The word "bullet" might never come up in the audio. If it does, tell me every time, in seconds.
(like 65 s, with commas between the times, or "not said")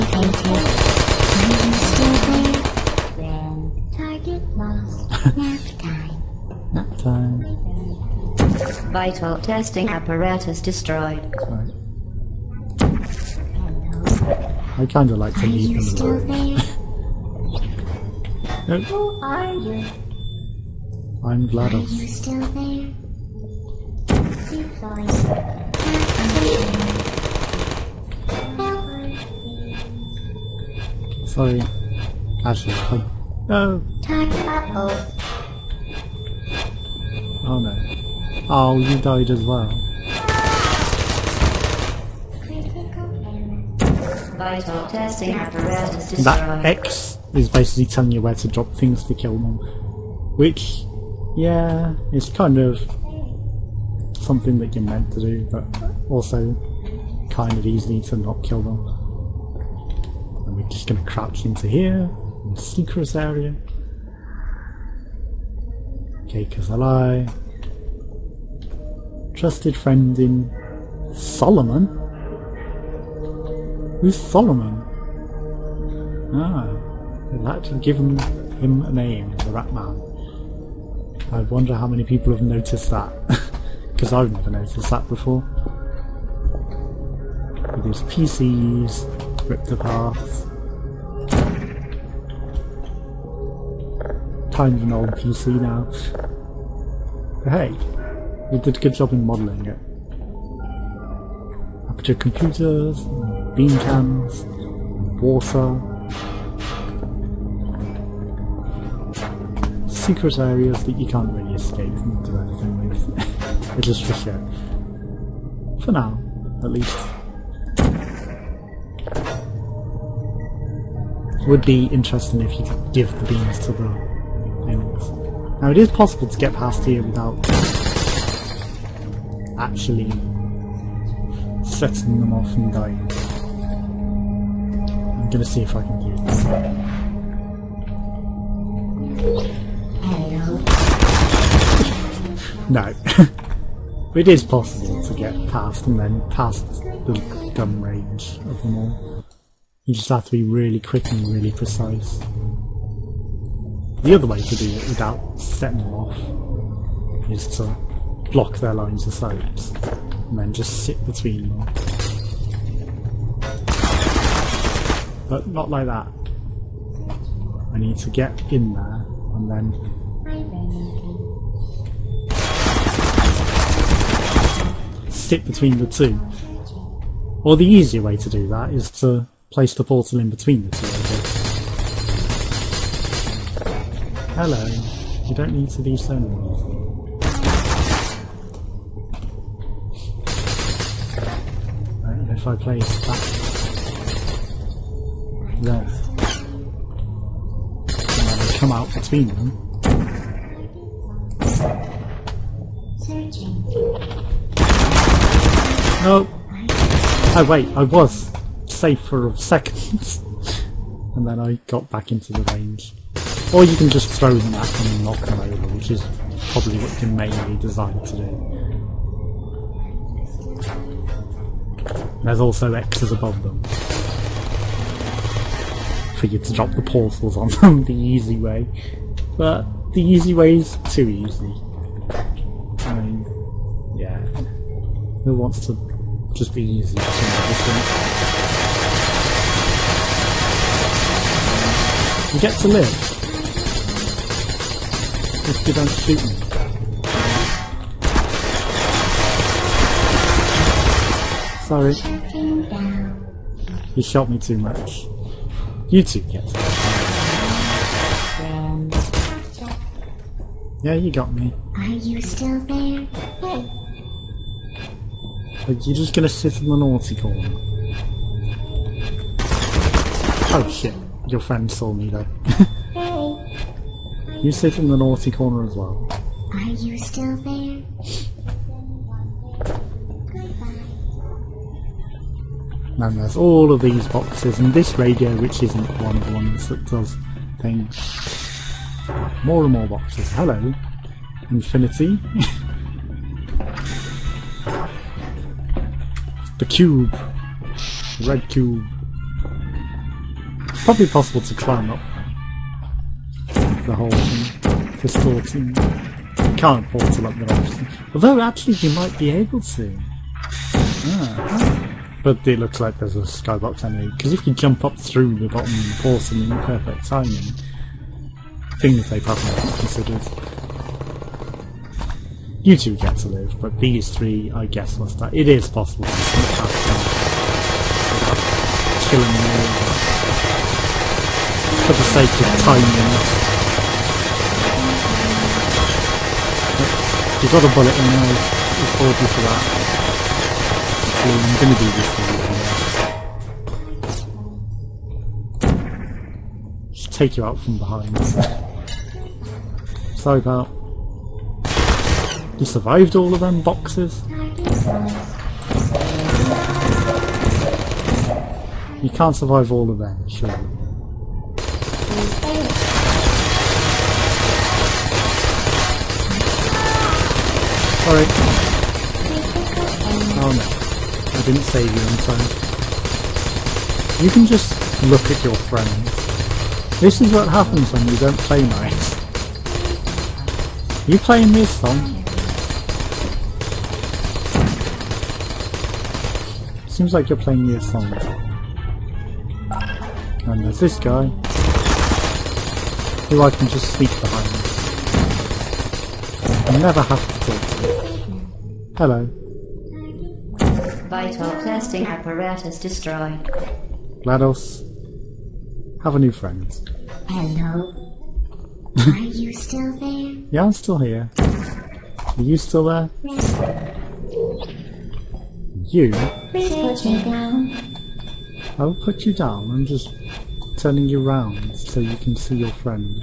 337 s.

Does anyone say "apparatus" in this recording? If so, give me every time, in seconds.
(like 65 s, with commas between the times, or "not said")
9 s, 45 s, 402 s.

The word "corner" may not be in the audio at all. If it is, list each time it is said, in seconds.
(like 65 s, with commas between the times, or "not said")
267 s, 275 s.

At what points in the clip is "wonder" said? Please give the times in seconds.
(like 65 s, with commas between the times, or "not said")
81 s.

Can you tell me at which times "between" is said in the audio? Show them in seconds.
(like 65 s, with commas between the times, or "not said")
161 s, 175 s, 180 s, 198 s.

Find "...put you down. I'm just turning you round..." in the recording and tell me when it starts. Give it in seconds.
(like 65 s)
418 s.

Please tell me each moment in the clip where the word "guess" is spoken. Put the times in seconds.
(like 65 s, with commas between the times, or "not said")
324 s.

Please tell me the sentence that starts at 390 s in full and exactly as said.
And there's this guy, who I can just sneak behind.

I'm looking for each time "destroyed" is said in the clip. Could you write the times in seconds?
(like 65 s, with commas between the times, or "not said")
10 s, 46 s, 402 s.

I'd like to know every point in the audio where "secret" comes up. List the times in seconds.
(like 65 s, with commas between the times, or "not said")
62 s, 110 s.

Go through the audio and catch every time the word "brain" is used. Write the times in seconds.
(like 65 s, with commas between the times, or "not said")
not said.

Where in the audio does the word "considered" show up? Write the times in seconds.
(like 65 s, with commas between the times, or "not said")
319 s.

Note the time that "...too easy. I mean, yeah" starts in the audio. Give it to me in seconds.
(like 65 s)
230 s.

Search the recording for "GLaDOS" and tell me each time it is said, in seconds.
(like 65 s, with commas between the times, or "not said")
21 s, 404 s.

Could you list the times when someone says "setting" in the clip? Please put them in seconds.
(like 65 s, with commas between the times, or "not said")
131 s, 155 s.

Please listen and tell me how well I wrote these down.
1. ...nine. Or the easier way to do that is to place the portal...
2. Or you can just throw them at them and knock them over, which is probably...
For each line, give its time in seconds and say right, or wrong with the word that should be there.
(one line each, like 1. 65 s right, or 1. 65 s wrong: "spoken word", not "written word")
1. 175 s wrong: "two", not "nine"
2. 213 s right.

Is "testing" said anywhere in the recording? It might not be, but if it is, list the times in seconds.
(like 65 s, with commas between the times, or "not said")
9 s, 44 s, 401 s.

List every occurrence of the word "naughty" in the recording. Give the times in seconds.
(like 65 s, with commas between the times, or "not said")
266 s, 274 s.